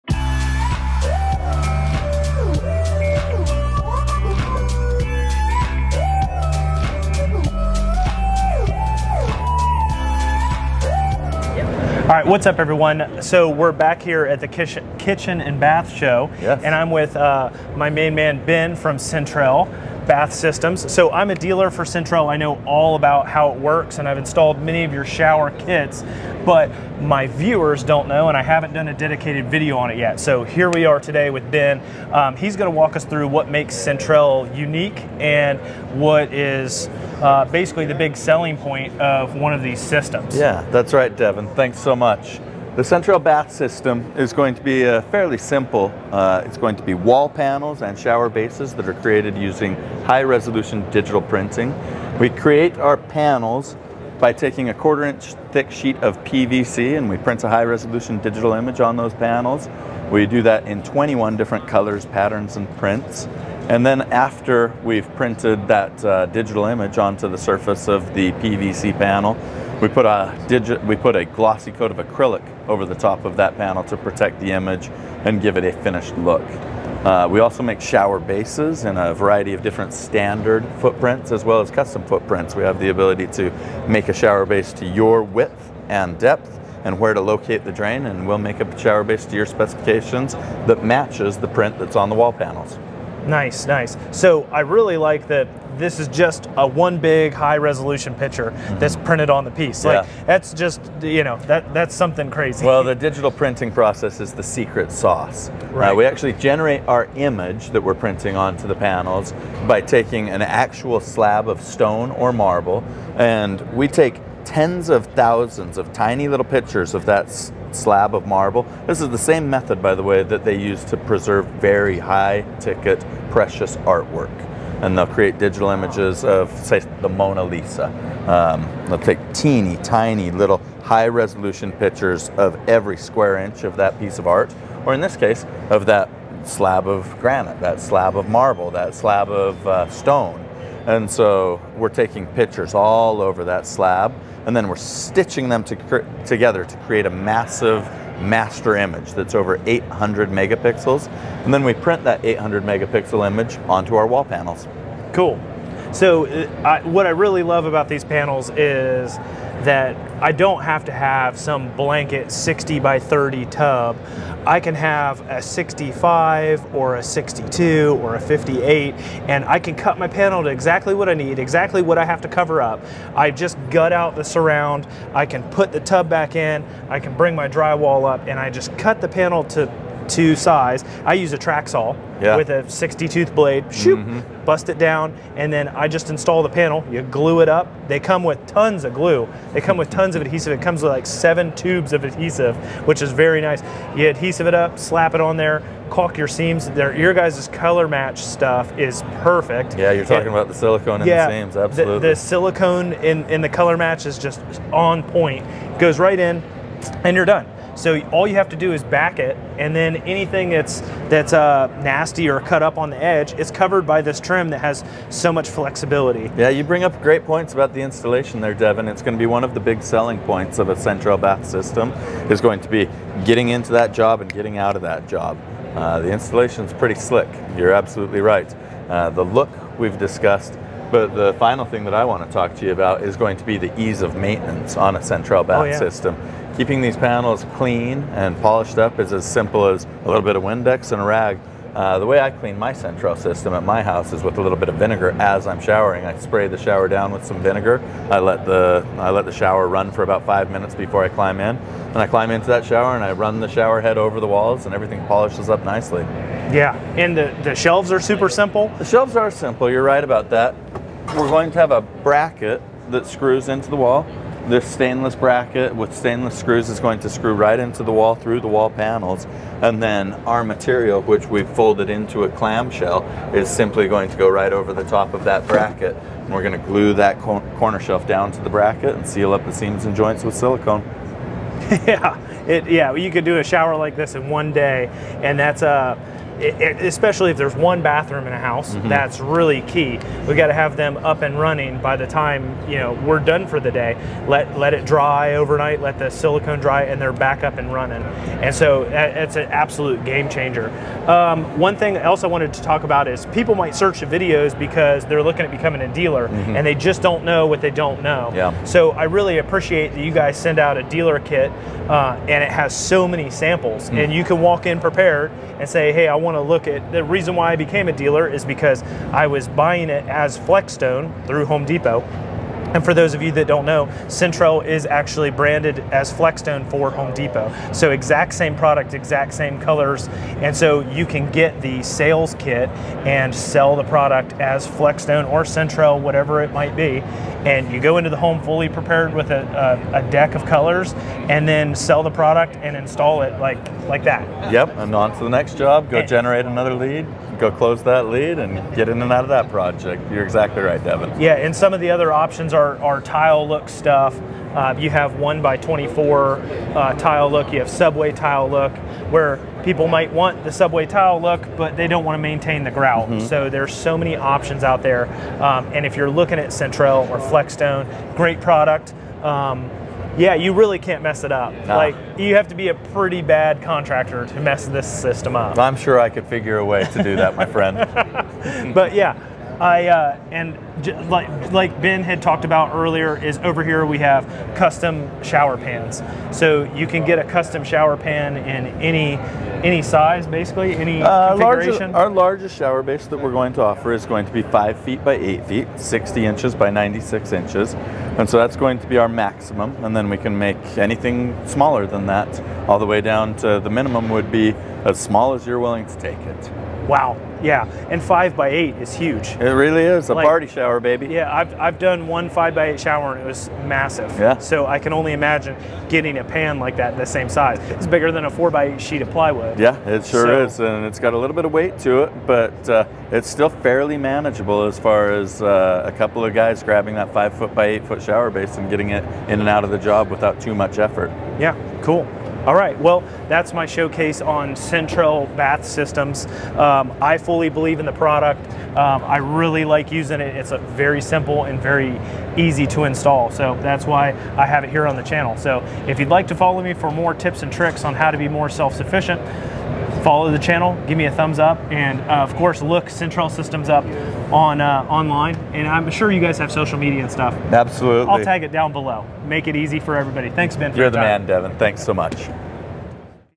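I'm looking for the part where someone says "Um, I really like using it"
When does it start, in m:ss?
7:18.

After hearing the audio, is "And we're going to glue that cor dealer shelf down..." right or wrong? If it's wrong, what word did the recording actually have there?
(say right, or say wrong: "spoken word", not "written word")
wrong: "corner", not "dealer".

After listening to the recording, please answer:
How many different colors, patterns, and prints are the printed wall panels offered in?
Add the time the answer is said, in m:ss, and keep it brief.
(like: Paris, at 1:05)
21, at 1:00.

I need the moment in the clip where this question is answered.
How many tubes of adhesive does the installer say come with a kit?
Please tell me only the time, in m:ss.
3:11.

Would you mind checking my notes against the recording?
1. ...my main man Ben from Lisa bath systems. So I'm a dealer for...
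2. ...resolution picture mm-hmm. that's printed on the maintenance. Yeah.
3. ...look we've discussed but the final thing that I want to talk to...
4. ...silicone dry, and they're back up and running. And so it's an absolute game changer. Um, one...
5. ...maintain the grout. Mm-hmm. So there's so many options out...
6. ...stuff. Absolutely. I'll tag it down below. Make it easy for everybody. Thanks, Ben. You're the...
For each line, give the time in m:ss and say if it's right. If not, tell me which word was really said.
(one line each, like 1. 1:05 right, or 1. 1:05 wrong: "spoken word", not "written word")
1. 0:17 wrong: "Sentrel", not "Lisa"
2. 1:37 wrong: "piece", not "maintenance"
3. 3:49 right
4. 4:56 right
5. 6:02 right
6. 7:37 right.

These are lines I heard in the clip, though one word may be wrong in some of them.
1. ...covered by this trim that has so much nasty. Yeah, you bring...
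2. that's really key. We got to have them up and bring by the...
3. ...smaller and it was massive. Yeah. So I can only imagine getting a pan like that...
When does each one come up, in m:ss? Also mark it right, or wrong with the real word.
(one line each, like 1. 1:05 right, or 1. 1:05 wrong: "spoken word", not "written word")
1. 3:33 wrong: "flexibility", not "nasty"
2. 4:48 wrong: "running", not "bring"
3. 6:52 wrong: "shower", not "smaller".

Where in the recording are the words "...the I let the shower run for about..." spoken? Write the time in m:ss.
4:08.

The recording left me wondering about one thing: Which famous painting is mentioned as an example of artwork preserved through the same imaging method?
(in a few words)
Mona Lisa.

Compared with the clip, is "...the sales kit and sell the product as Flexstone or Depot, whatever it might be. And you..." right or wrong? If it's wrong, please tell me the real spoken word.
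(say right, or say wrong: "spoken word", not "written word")
wrong: "Sentrel", not "Depot".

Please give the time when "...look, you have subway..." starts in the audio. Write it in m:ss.
5:57.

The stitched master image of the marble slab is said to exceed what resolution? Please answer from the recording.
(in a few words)
800 megapixels.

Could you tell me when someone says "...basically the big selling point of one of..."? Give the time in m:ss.
0:37.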